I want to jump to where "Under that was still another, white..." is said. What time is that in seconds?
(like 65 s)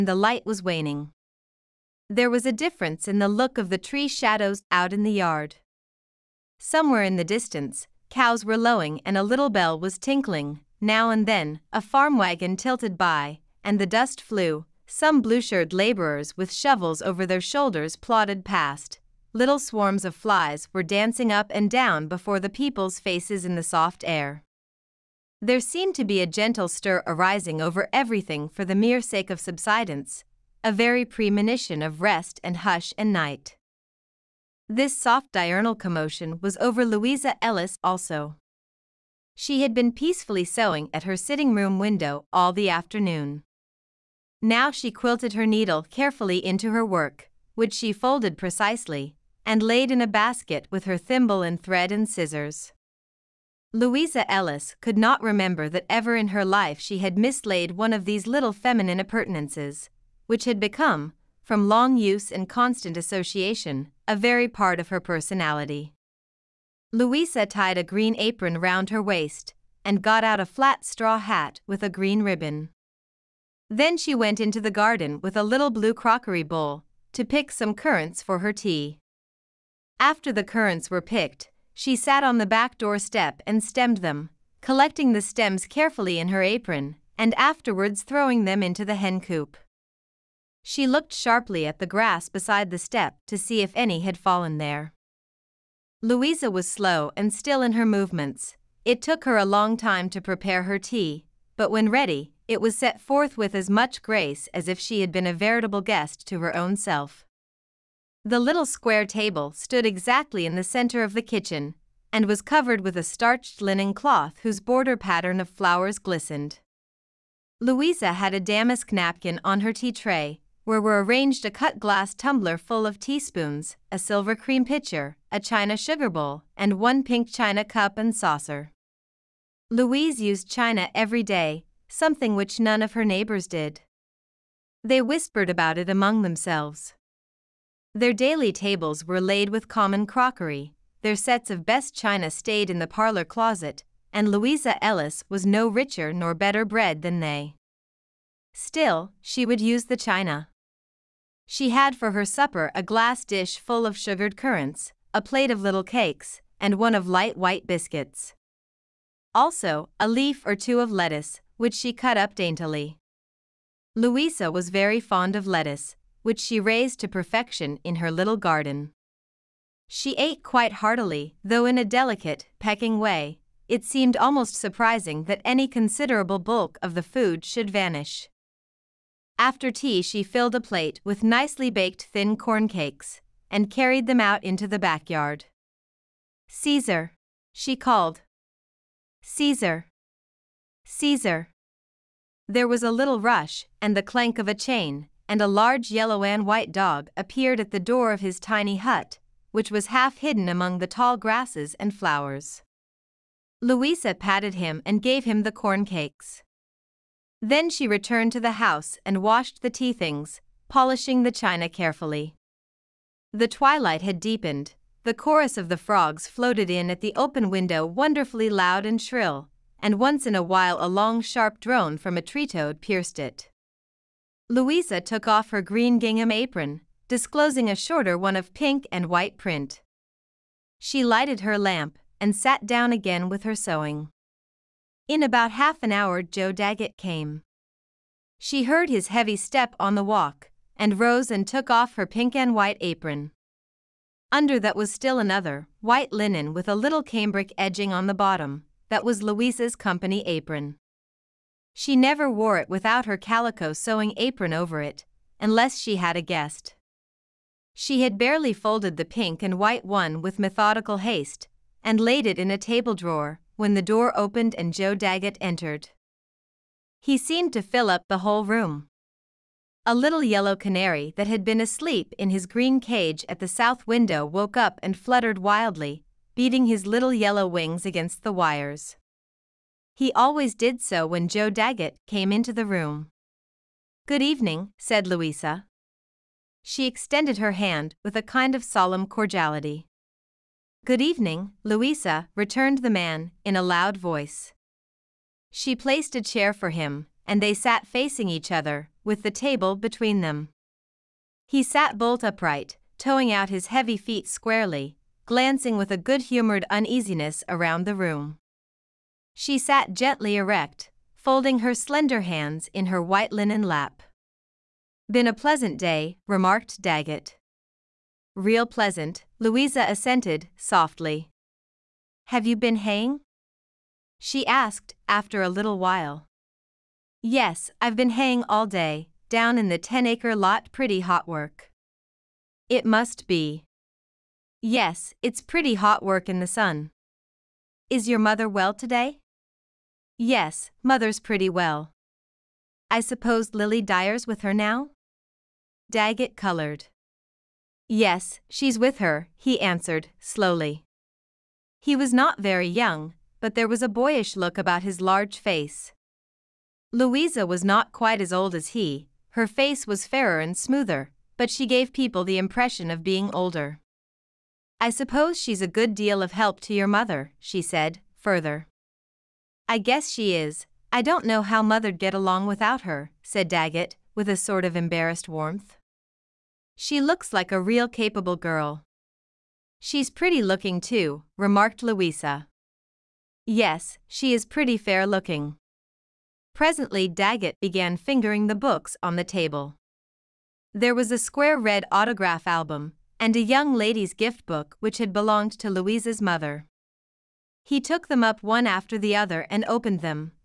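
244 s.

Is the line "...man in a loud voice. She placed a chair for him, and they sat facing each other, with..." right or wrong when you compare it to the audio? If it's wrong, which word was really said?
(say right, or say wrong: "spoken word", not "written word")
right.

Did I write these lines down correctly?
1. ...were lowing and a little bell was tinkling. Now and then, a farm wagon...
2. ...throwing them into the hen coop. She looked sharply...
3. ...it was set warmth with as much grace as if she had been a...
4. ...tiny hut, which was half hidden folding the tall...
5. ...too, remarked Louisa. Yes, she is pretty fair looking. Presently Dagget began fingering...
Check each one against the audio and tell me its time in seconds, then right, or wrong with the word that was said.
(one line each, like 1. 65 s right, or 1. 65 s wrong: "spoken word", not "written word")
1. 8 s right
2. 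88 s right
3. 102 s wrong: "forth", not "warmth"
4. 198 s wrong: "among", not "folding"
5. 380 s right.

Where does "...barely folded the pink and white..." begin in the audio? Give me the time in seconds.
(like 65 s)
258 s.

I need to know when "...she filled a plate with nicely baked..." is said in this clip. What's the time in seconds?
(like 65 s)
180 s.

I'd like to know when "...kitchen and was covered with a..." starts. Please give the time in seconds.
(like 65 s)
111 s.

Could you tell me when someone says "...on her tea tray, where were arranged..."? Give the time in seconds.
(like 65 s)
119 s.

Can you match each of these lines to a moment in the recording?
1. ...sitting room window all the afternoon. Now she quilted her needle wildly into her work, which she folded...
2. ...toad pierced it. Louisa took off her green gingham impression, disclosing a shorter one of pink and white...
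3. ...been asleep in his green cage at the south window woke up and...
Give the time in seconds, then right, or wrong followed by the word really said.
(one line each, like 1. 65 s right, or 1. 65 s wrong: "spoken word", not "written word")
1. 41 s wrong: "carefully", not "wildly"
2. 222 s wrong: "apron", not "impression"
3. 271 s right.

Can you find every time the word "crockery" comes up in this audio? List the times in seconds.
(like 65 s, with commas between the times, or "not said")
75 s, 140 s.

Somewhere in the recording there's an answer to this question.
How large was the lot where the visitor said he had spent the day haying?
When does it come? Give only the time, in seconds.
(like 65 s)
329 s.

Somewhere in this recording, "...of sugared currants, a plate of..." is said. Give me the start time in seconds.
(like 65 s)
153 s.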